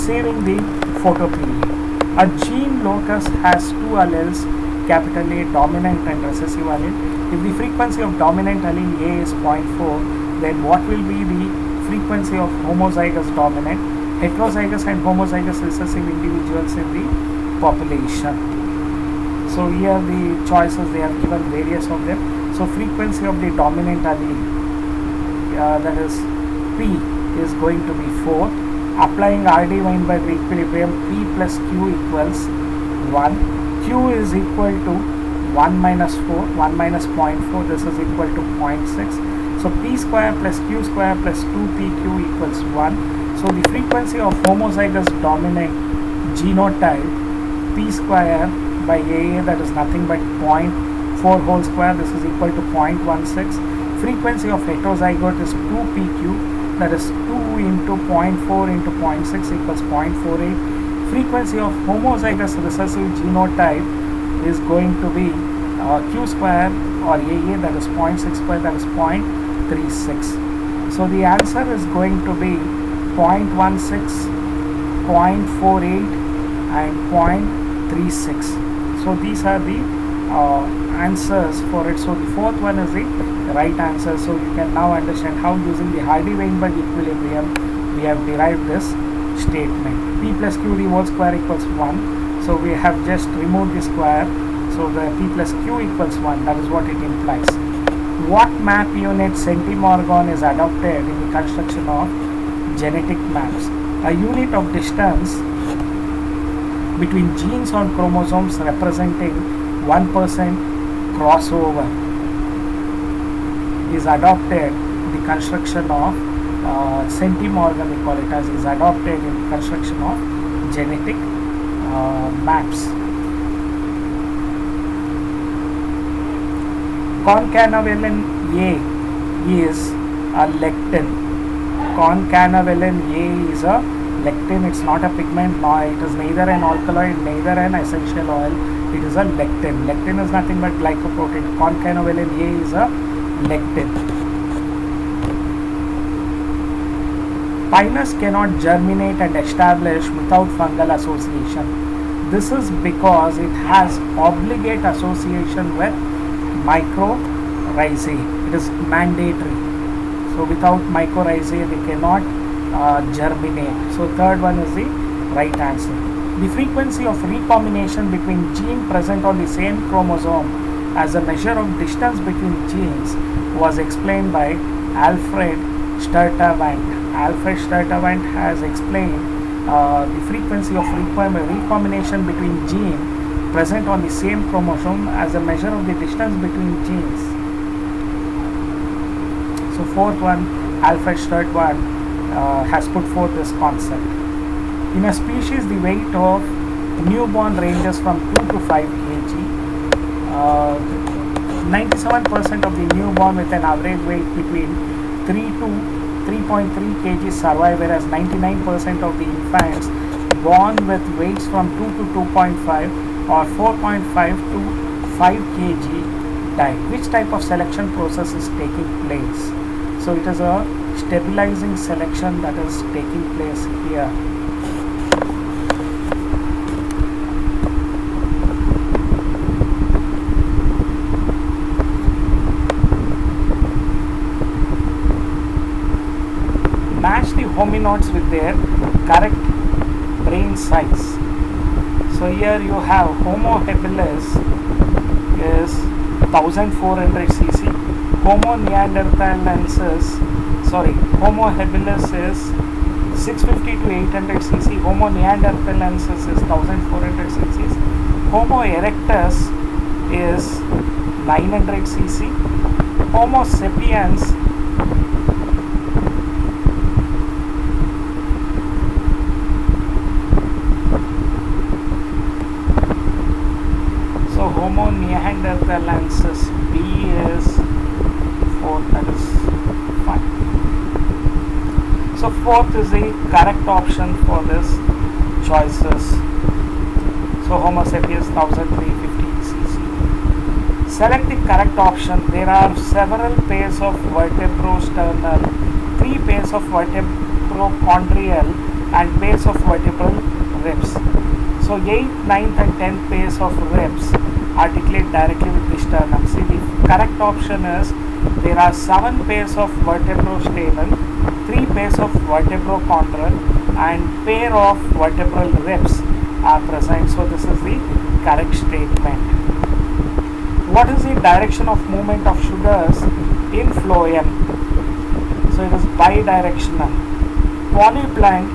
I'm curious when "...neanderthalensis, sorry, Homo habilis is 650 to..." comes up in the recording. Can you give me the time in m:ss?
4:08.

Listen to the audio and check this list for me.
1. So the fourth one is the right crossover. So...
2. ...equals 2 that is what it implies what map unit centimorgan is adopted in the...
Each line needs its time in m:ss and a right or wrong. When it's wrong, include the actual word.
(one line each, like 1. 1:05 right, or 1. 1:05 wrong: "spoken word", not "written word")
1. 1:21 wrong: "answer", not "crossover"
2. 1:35 wrong: "1", not "2".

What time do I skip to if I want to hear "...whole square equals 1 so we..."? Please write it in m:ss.
1:30.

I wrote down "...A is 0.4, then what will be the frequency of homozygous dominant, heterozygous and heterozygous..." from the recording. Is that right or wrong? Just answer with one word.
wrong.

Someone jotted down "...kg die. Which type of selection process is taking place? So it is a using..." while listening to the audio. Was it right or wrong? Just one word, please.
wrong.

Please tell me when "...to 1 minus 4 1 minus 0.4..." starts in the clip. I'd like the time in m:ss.
0:34.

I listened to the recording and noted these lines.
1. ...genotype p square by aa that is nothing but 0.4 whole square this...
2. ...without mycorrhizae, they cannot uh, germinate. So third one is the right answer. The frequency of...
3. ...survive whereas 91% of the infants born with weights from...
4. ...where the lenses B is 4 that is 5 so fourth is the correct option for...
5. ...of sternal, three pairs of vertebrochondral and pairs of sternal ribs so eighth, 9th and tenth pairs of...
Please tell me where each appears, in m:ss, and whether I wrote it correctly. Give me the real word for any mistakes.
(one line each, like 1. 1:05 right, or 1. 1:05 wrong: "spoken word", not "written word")
1. 0:46 right
2. 2:40 right
3. 3:27 wrong: "99", not "91"
4. 4:35 right
5. 4:53 wrong: "vertebral", not "sternal".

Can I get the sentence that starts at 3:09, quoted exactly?
So fourth one, Alfred Sturtevant uh, has put forth this concept.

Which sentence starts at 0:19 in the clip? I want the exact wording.
So here the choices they have given various of them.